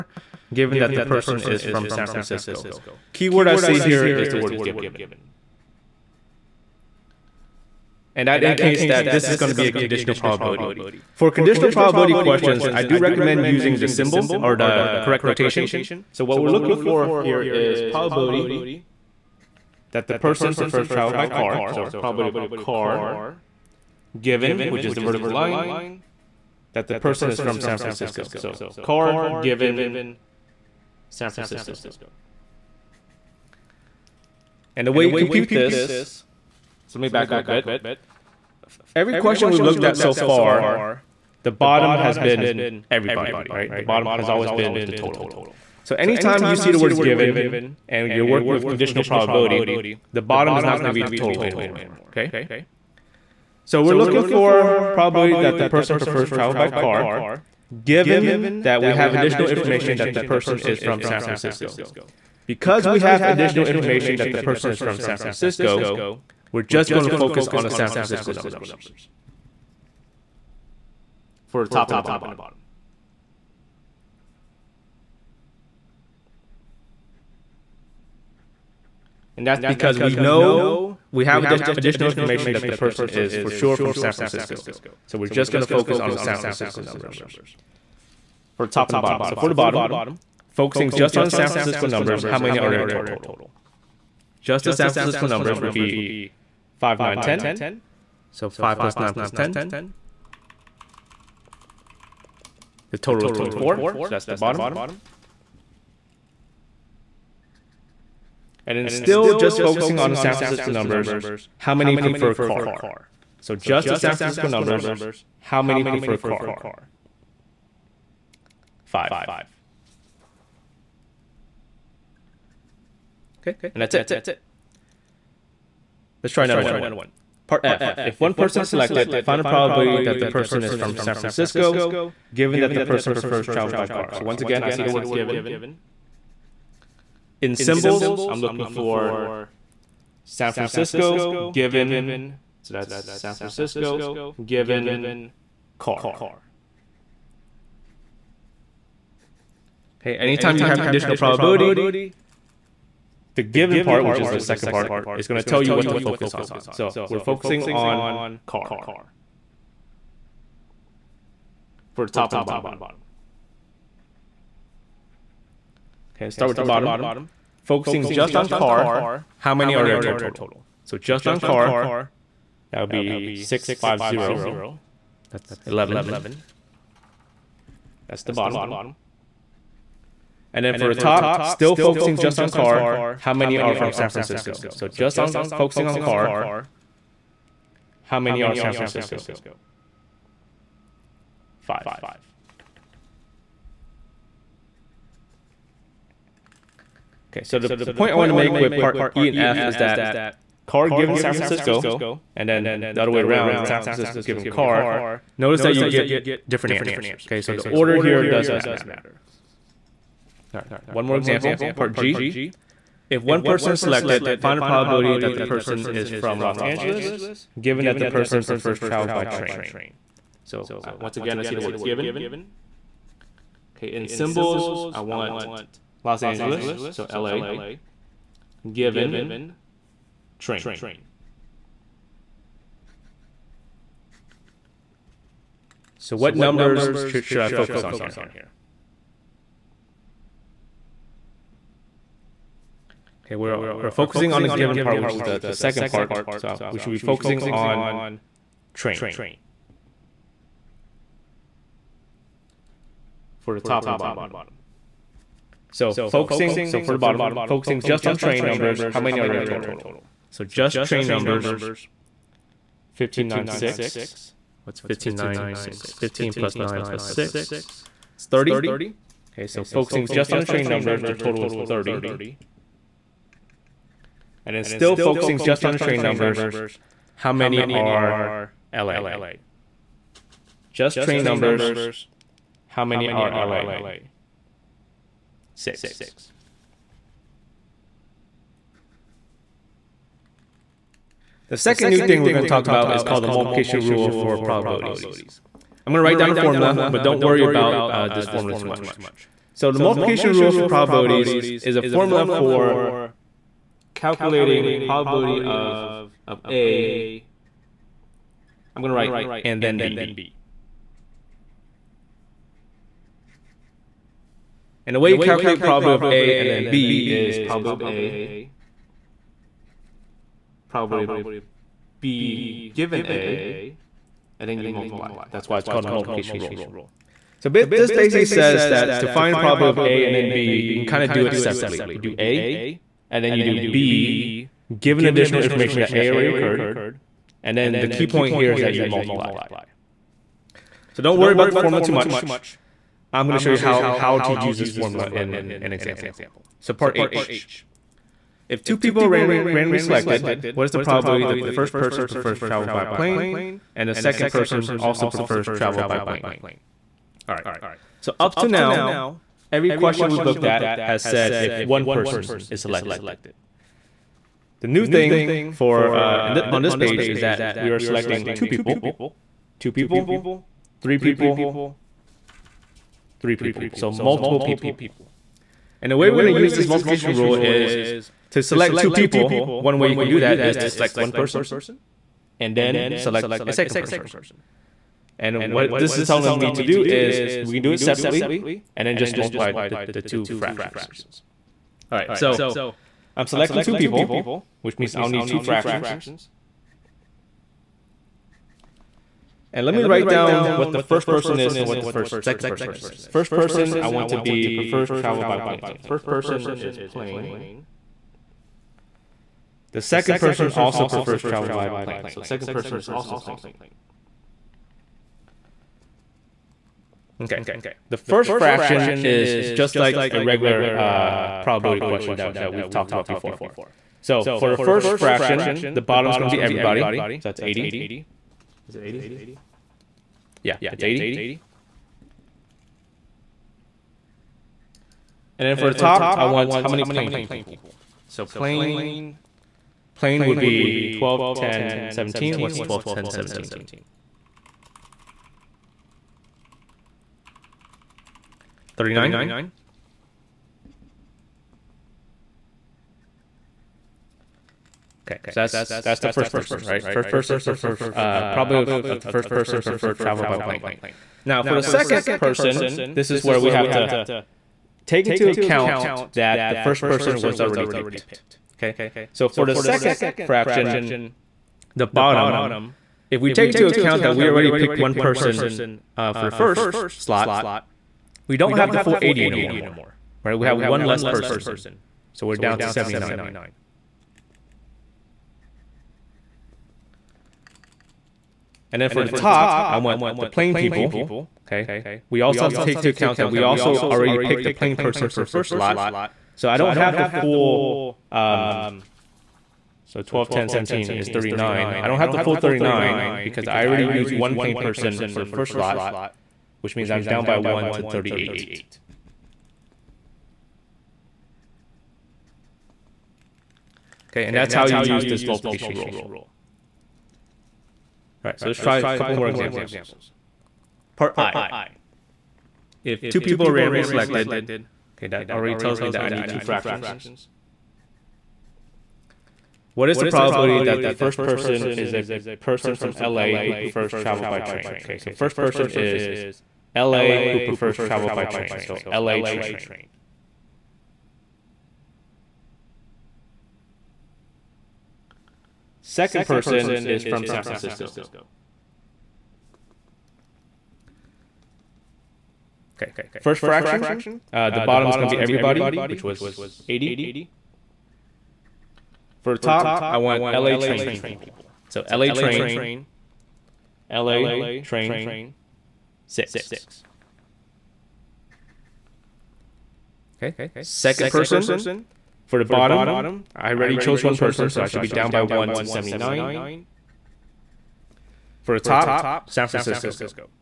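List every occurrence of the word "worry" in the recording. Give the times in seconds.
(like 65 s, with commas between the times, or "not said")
297 s, 341 s.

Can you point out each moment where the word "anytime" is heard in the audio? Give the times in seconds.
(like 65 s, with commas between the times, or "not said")
45 s, 150 s.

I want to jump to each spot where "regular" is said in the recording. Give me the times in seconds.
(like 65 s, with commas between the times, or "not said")
420 s.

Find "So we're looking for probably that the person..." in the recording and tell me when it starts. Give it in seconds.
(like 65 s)
53 s.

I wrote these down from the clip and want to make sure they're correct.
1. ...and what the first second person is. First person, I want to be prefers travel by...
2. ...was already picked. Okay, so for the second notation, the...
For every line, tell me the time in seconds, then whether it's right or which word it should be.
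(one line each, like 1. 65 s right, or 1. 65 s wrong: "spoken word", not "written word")
1. 401 s right
2. 467 s wrong: "fraction", not "notation".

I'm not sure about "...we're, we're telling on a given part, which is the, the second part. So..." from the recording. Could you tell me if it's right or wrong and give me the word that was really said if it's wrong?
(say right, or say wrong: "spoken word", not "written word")
wrong: "focusing", not "telling".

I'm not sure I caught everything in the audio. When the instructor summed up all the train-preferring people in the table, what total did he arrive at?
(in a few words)
30.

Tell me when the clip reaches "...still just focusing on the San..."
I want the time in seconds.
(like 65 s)
108 s.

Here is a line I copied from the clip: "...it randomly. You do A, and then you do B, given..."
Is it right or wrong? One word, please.
wrong.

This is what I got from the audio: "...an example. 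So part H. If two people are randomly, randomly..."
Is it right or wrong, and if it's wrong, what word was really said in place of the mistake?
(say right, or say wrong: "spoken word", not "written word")
right.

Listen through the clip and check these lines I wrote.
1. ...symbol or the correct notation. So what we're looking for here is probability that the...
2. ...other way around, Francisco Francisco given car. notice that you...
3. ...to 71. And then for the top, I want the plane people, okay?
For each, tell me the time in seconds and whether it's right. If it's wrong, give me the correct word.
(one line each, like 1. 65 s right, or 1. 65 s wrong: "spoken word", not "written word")
1. 13 s right
2. 203 s wrong: "San", not "Francisco"
3. 482 s wrong: "79", not "71".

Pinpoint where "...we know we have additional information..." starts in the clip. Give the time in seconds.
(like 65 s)
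79 s.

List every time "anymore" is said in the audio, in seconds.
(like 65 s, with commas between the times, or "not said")
51 s, 479 s.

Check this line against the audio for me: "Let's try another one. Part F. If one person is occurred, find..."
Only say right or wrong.
wrong.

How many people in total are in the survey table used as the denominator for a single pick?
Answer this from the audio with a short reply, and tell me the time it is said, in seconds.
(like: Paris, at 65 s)
80, at 427 s.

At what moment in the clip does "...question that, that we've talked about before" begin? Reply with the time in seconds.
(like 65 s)
421 s.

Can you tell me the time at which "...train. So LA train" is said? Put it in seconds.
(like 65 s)
538 s.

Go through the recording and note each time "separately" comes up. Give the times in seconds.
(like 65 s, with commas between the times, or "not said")
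331 s, 387 s.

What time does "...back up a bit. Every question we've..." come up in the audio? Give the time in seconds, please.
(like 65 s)
37 s.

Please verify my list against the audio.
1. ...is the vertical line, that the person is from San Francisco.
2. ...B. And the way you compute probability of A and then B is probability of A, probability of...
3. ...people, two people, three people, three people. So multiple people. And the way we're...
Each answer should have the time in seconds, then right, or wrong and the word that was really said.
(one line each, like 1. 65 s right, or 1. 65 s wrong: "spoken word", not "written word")
1. 24 s right
2. 309 s wrong: "calculate", not "compute"
3. 368 s right.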